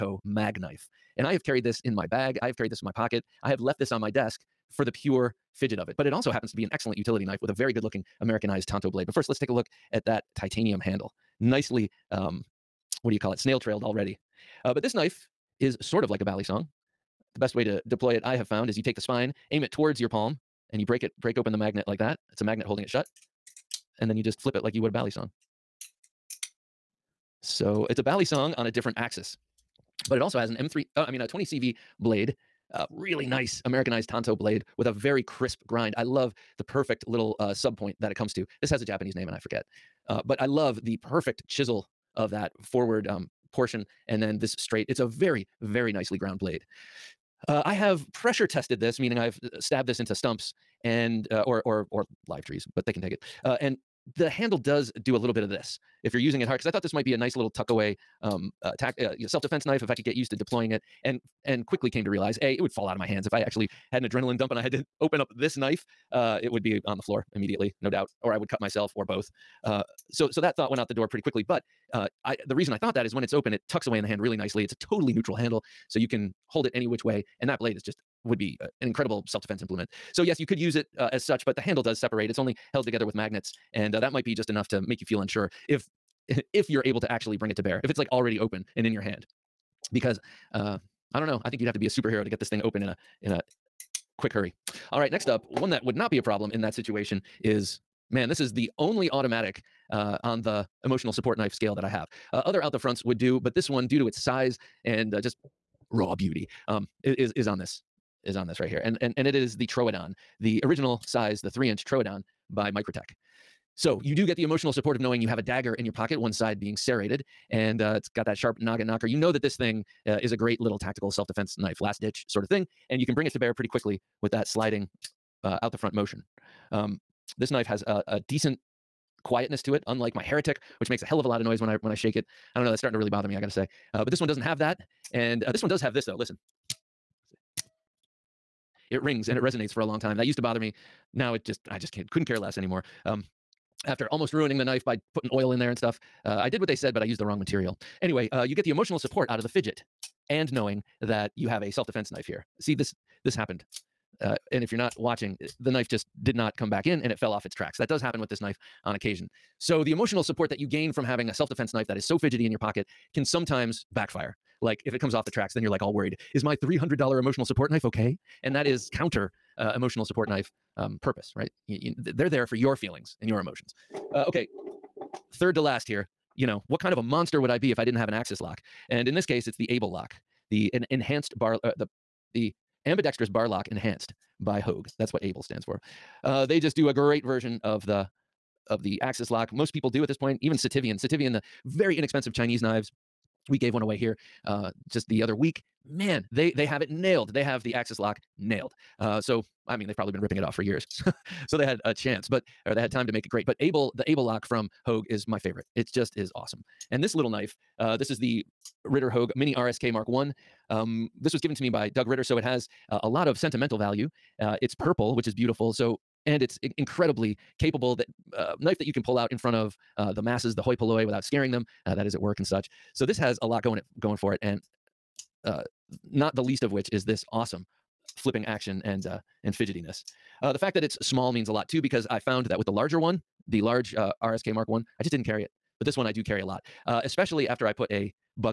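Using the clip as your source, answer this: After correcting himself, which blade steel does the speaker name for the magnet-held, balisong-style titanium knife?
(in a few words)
20CV.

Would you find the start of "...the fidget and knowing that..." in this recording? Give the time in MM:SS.
02:29.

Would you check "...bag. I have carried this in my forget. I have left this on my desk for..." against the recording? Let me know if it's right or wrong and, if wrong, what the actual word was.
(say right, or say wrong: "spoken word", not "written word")
wrong: "pocket", not "forget".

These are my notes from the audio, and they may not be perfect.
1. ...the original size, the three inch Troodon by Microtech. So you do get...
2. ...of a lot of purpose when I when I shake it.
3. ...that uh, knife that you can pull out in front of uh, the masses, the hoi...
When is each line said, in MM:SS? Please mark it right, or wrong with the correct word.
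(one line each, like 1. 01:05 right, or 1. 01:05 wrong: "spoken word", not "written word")
1. 01:50 right
2. 02:11 wrong: "noise", not "purpose"
3. 03:37 right.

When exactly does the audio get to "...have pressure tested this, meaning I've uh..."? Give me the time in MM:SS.
00:47.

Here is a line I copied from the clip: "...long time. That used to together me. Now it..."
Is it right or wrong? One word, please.
wrong.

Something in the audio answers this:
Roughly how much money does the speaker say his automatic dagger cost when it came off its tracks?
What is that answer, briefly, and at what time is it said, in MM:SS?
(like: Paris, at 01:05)
$300, at 02:46.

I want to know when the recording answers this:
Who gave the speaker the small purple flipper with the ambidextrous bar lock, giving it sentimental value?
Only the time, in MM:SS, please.
03:31.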